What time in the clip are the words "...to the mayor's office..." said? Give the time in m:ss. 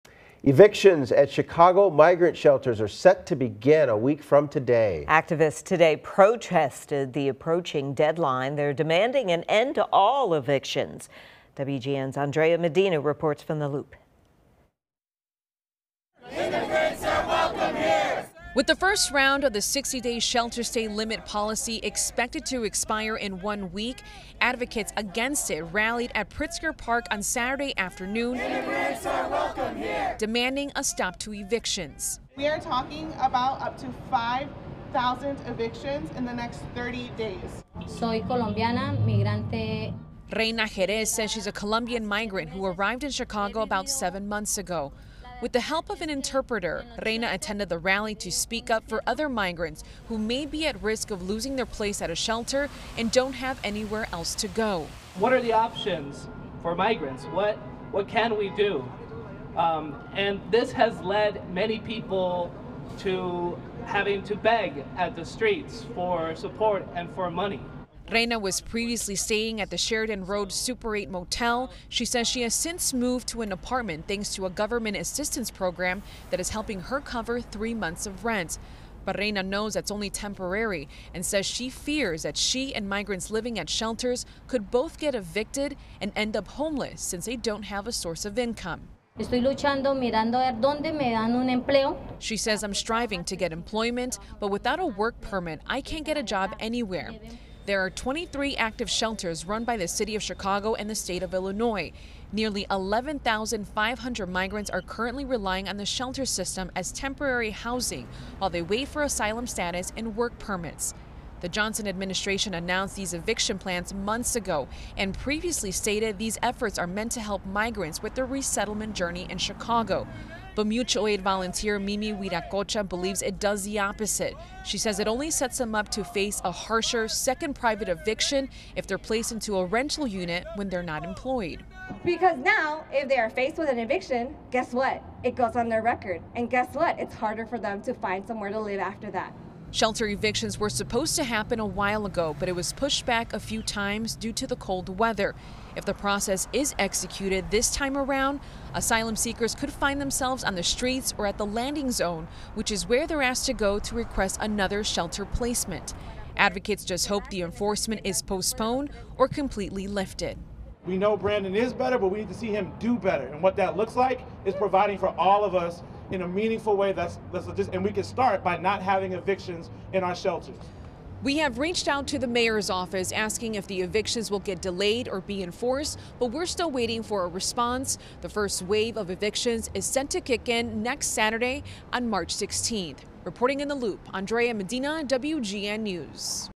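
2:52.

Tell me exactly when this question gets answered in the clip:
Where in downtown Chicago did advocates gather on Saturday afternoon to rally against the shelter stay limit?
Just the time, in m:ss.
0:26.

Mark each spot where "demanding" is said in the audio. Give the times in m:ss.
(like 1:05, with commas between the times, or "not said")
0:08, 0:30.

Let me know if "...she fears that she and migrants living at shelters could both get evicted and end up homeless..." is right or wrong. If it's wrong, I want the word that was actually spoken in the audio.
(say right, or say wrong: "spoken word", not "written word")
right.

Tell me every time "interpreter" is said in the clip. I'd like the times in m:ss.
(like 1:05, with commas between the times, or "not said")
0:46.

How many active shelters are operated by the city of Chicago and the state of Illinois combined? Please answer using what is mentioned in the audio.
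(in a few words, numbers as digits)
23.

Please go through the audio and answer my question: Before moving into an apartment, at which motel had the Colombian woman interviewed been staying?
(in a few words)
Sheridan Road Super 8.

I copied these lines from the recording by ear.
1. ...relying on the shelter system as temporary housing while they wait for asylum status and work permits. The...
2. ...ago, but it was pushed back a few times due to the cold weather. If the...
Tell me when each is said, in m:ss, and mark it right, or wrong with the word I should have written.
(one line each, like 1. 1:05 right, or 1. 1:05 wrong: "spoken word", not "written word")
1. 1:45 right
2. 2:22 right.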